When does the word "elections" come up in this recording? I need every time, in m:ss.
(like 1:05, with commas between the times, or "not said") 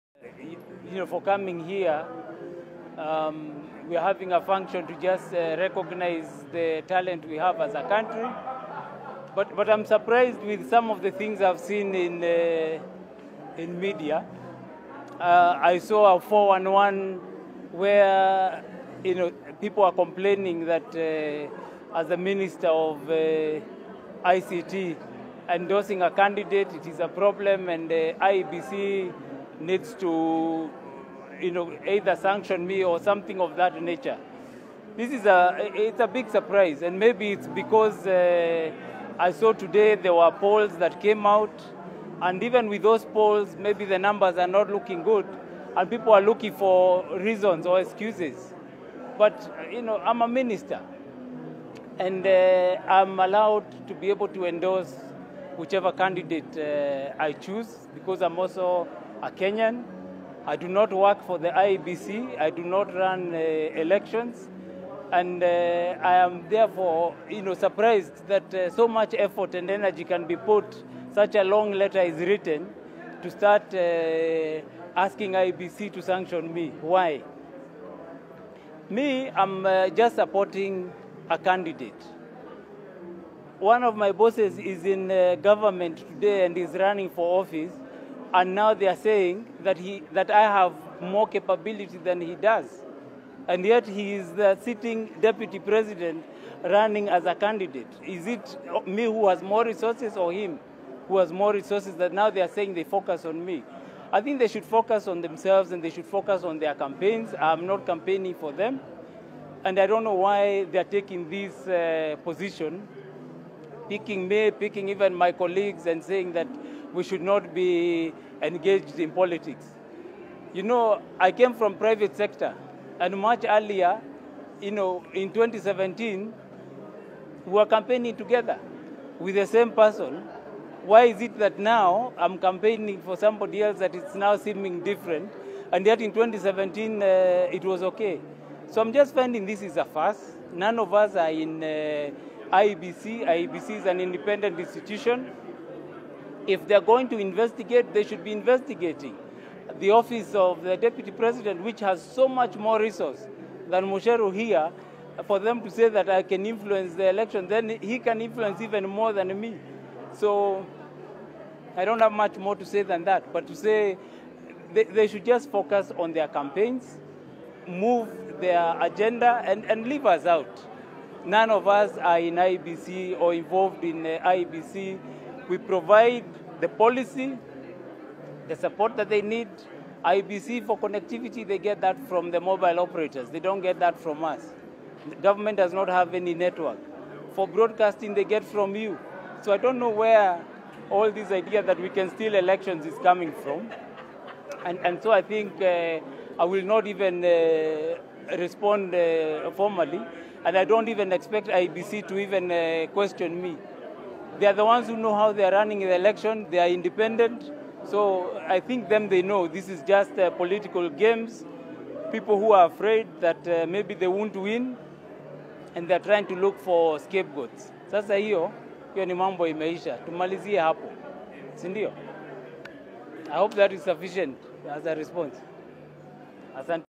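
1:03, 2:37, 3:12, 3:25.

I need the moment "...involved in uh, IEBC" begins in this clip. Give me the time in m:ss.
2:53.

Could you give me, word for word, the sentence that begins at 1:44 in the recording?
I think they should focus on themselves and they should focus on their campaigns.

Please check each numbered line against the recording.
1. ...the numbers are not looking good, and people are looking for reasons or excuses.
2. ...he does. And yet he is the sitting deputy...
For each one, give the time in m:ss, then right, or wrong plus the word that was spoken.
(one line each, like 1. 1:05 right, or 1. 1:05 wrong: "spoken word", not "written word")
1. 0:43 right
2. 1:32 right.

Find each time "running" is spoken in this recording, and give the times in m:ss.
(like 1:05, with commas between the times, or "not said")
1:26, 1:36, 3:25.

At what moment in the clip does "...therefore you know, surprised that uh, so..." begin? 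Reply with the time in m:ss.
1:06.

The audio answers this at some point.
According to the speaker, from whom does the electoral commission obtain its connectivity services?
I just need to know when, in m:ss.
3:02.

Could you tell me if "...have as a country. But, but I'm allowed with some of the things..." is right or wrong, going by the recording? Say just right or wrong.
wrong.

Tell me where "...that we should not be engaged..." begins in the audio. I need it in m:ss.
1:56.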